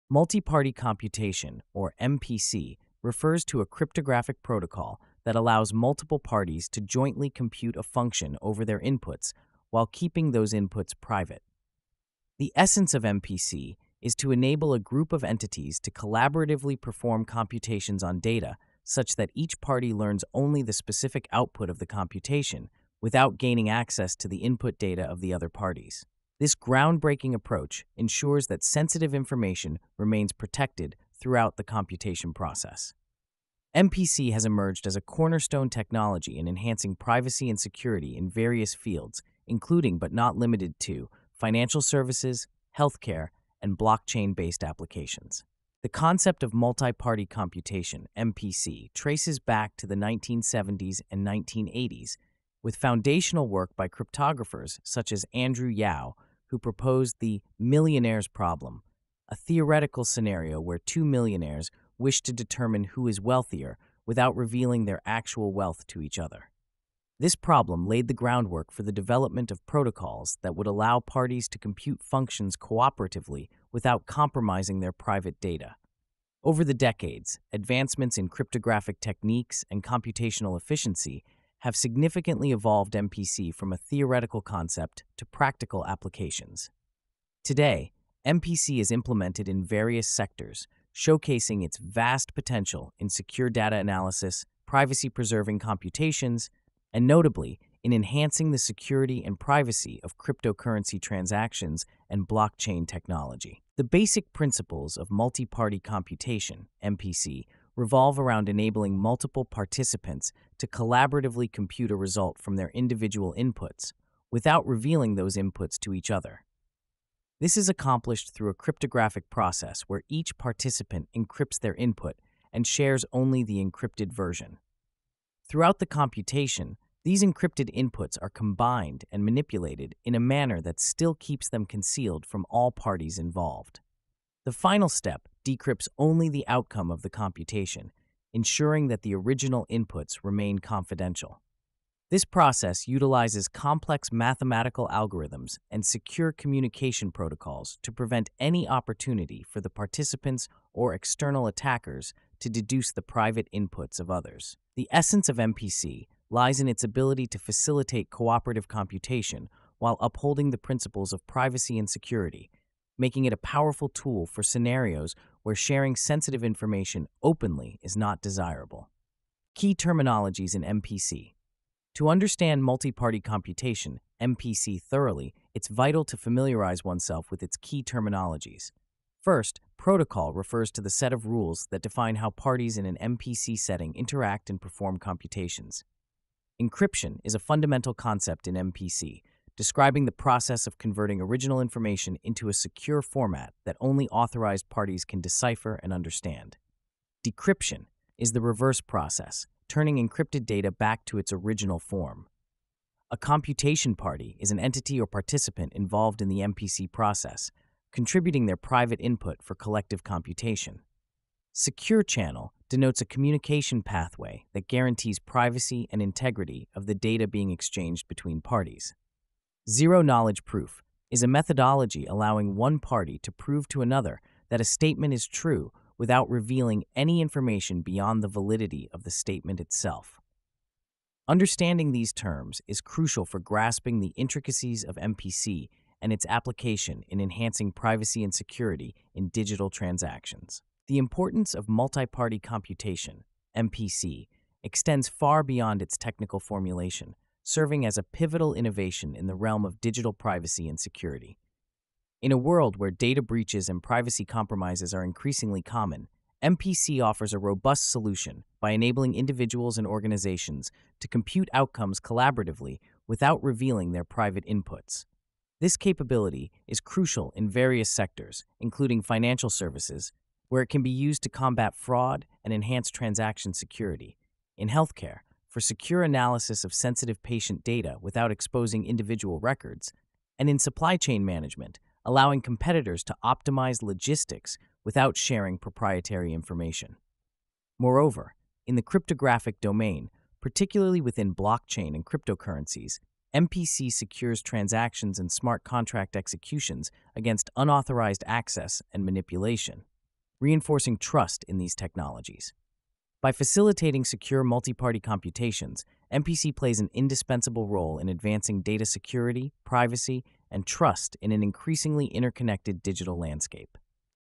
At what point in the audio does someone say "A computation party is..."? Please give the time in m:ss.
3:23.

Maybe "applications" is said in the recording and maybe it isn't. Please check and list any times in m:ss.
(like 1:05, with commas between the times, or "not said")
0:44, 1:25, 3:56.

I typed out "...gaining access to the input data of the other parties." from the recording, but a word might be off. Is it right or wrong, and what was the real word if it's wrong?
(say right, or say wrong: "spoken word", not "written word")
right.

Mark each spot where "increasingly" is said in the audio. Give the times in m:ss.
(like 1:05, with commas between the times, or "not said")
4:15, 5:11.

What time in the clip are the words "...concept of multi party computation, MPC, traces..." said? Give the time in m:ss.
0:45.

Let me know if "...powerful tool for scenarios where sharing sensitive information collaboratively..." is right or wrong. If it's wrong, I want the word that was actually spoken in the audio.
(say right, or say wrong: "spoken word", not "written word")
wrong: "openly", not "collaboratively".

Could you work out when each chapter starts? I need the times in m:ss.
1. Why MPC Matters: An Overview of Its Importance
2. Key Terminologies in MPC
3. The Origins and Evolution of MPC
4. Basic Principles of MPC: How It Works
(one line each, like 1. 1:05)
1. 4:01
2. 2:49
3. 0:46
4. 1:44.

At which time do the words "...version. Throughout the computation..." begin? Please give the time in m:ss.
2:04.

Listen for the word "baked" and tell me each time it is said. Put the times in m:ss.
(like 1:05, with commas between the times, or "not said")
not said.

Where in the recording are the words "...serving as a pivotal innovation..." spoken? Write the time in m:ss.
4:07.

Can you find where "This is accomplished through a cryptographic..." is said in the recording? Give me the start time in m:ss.
1:57.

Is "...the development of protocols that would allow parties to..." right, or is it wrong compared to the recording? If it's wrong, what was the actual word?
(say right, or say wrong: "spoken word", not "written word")
right.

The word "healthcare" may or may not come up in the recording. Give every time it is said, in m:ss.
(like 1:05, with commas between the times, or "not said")
0:42, 4:34.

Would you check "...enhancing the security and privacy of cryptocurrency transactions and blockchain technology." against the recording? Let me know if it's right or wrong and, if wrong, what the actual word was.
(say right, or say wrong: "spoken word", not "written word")
right.